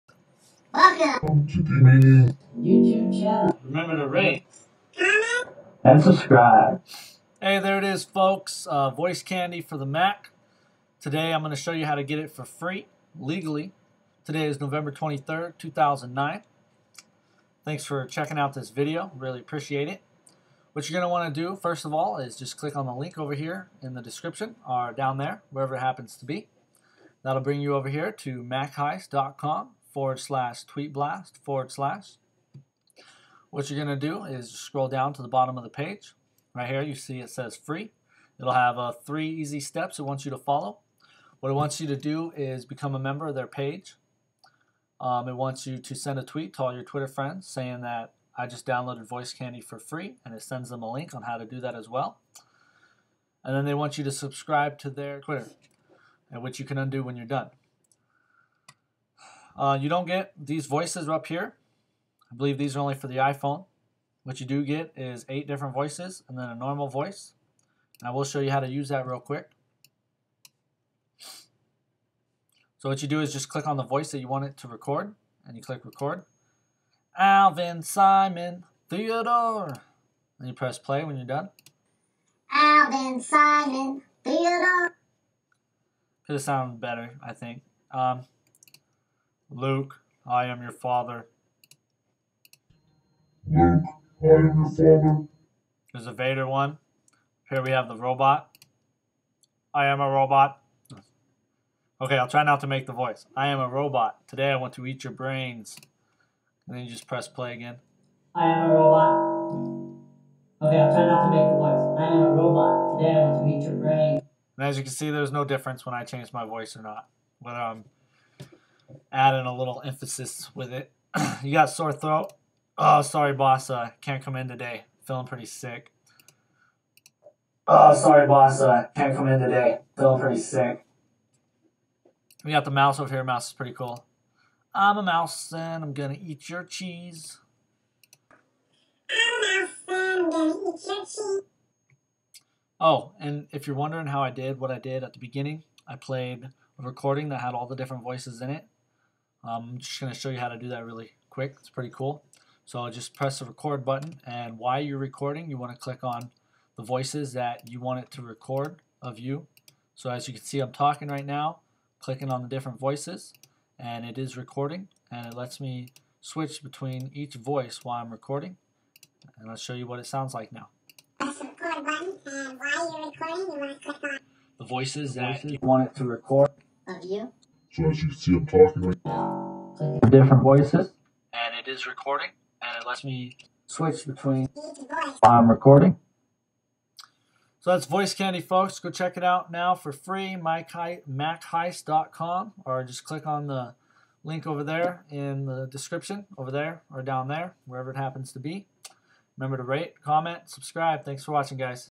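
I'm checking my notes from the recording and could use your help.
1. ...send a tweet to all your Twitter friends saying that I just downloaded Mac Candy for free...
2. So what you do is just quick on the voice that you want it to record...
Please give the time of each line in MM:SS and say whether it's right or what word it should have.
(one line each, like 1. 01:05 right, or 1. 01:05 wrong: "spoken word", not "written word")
1. 00:45 wrong: "Voice", not "Mac"
2. 01:12 wrong: "click", not "quick".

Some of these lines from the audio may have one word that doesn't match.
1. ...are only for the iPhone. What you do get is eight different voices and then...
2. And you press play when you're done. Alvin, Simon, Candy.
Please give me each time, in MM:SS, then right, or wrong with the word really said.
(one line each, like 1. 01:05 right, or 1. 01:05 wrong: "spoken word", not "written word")
1. 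01:02 right
2. 01:20 wrong: "Theodore", not "Candy".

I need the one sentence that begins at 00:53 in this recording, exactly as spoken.
And then they want you to subscribe to their Twitter, which you can undo when you're done.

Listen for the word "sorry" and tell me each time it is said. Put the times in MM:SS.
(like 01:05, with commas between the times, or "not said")
02:03, 02:07.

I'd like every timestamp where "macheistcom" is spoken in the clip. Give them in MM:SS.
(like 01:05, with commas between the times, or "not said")
00:28, 03:10.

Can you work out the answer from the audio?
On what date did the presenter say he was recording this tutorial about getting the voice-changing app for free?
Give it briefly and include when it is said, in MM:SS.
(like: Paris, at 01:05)
November 23rd, 2009, at 00:14.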